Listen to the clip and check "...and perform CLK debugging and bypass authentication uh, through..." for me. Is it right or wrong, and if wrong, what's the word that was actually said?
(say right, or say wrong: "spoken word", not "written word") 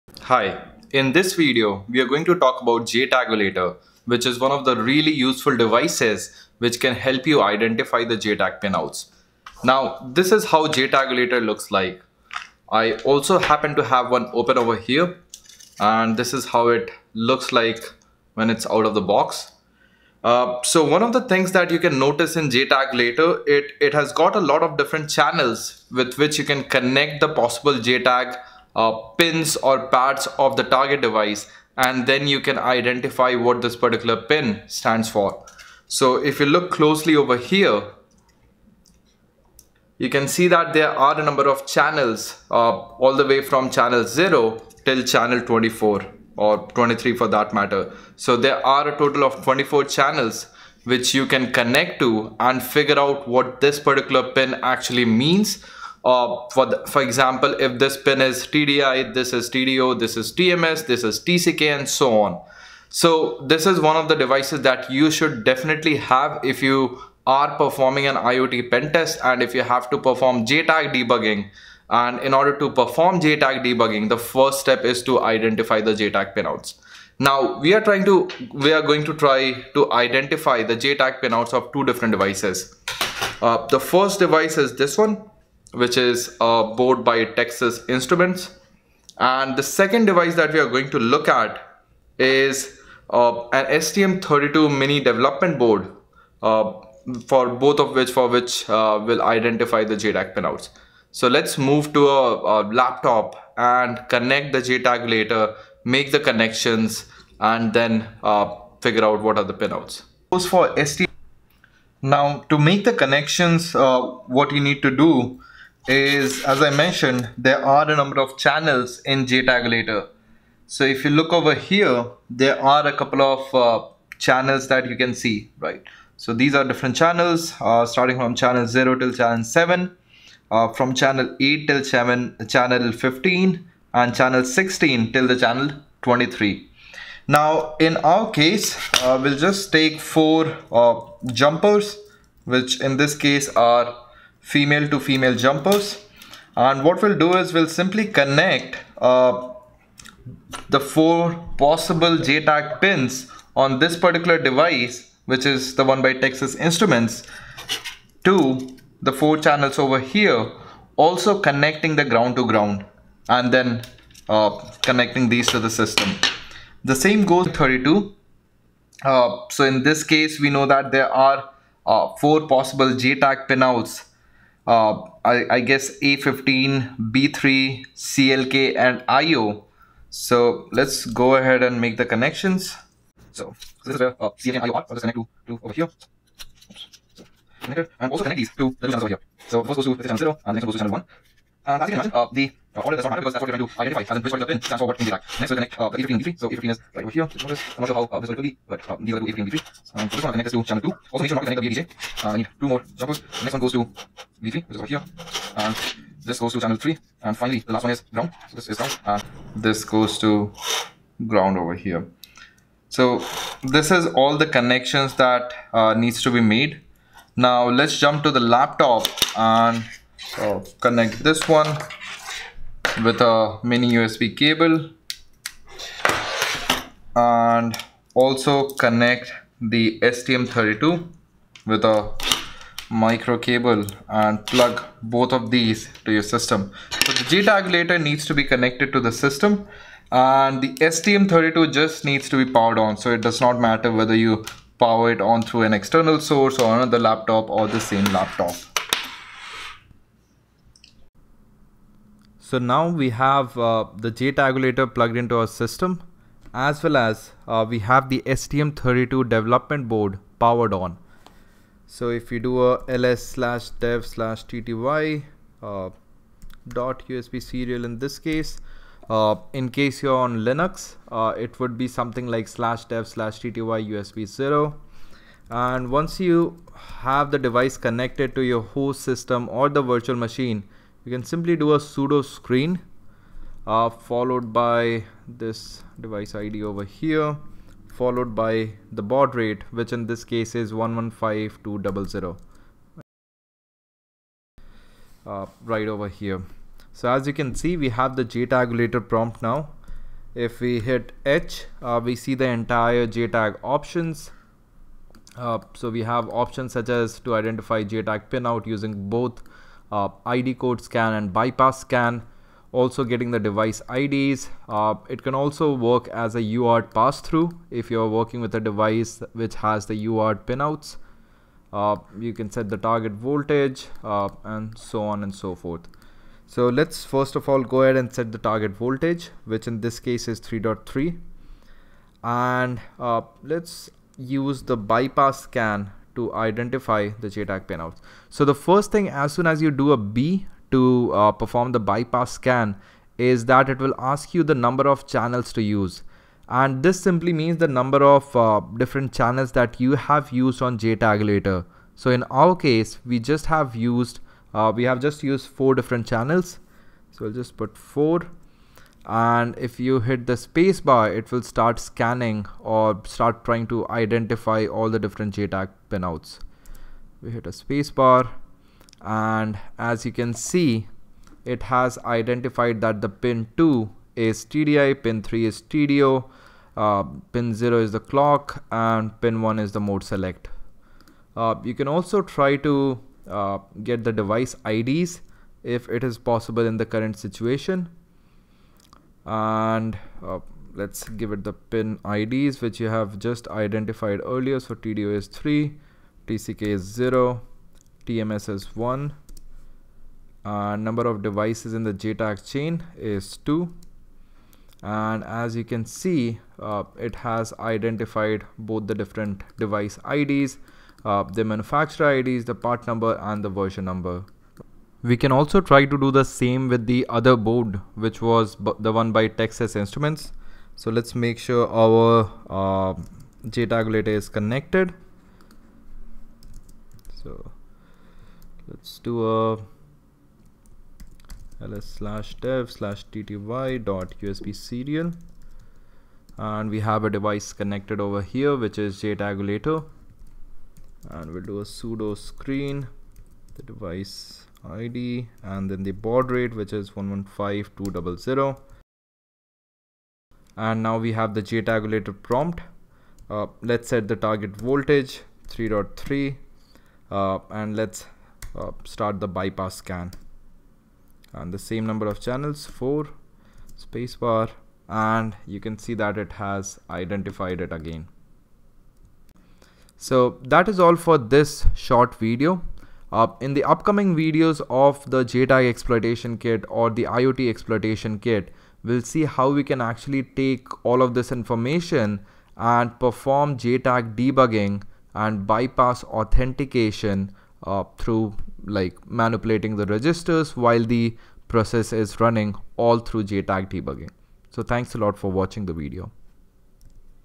wrong: "JTAG", not "CLK".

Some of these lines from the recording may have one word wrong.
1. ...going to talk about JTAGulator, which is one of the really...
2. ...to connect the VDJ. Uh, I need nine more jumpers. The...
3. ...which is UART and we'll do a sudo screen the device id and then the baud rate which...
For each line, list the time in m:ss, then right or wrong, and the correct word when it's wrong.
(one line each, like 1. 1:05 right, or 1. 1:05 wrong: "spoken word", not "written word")
1. 0:02 right
2. 3:21 wrong: "two", not "nine"
3. 7:18 wrong: "JTAGulator", not "UART".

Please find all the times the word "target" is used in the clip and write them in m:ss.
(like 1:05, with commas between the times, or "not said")
0:30, 5:22, 5:28, 7:34.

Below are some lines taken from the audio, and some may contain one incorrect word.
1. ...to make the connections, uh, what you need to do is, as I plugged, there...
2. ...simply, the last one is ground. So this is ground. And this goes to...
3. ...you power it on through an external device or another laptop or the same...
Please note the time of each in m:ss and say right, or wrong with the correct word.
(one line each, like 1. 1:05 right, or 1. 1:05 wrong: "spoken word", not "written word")
1. 1:52 wrong: "mentioned", not "plugged"
2. 3:27 wrong: "finally", not "simply"
3. 4:04 wrong: "source", not "device".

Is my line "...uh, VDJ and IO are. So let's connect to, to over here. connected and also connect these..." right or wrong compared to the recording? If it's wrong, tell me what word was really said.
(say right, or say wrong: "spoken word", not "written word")
wrong: "CLK", not "VDJ".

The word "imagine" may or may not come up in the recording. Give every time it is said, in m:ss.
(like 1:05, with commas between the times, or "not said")
3:12.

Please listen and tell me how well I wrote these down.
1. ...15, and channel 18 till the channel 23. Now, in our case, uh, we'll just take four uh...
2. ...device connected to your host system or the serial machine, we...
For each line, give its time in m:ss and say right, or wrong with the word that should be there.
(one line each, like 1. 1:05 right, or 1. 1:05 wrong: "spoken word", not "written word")
1. 2:12 wrong: "16", not "18"
2. 4:37 wrong: "virtual", not "serial".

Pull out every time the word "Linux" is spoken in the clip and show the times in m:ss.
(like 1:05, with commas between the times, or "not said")
4:30.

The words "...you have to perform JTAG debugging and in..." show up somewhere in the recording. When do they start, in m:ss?
1:09.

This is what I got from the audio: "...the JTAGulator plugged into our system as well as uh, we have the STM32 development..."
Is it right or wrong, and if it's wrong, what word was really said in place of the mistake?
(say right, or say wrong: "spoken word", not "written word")
right.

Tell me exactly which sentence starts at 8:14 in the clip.
So thanks a lot for watching the video.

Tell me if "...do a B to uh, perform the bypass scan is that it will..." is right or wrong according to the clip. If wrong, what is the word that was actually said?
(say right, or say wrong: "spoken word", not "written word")
right.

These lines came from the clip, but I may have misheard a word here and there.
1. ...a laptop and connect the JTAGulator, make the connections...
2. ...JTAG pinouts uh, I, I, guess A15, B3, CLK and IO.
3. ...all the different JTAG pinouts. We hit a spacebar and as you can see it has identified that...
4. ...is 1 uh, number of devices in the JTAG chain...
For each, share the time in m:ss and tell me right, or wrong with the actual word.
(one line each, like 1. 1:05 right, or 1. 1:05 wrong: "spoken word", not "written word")
1. 1:42 right
2. 2:52 right
3. 6:04 right
4. 6:38 right.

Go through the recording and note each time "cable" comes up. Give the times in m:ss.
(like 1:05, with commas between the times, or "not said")
3:44, 3:53.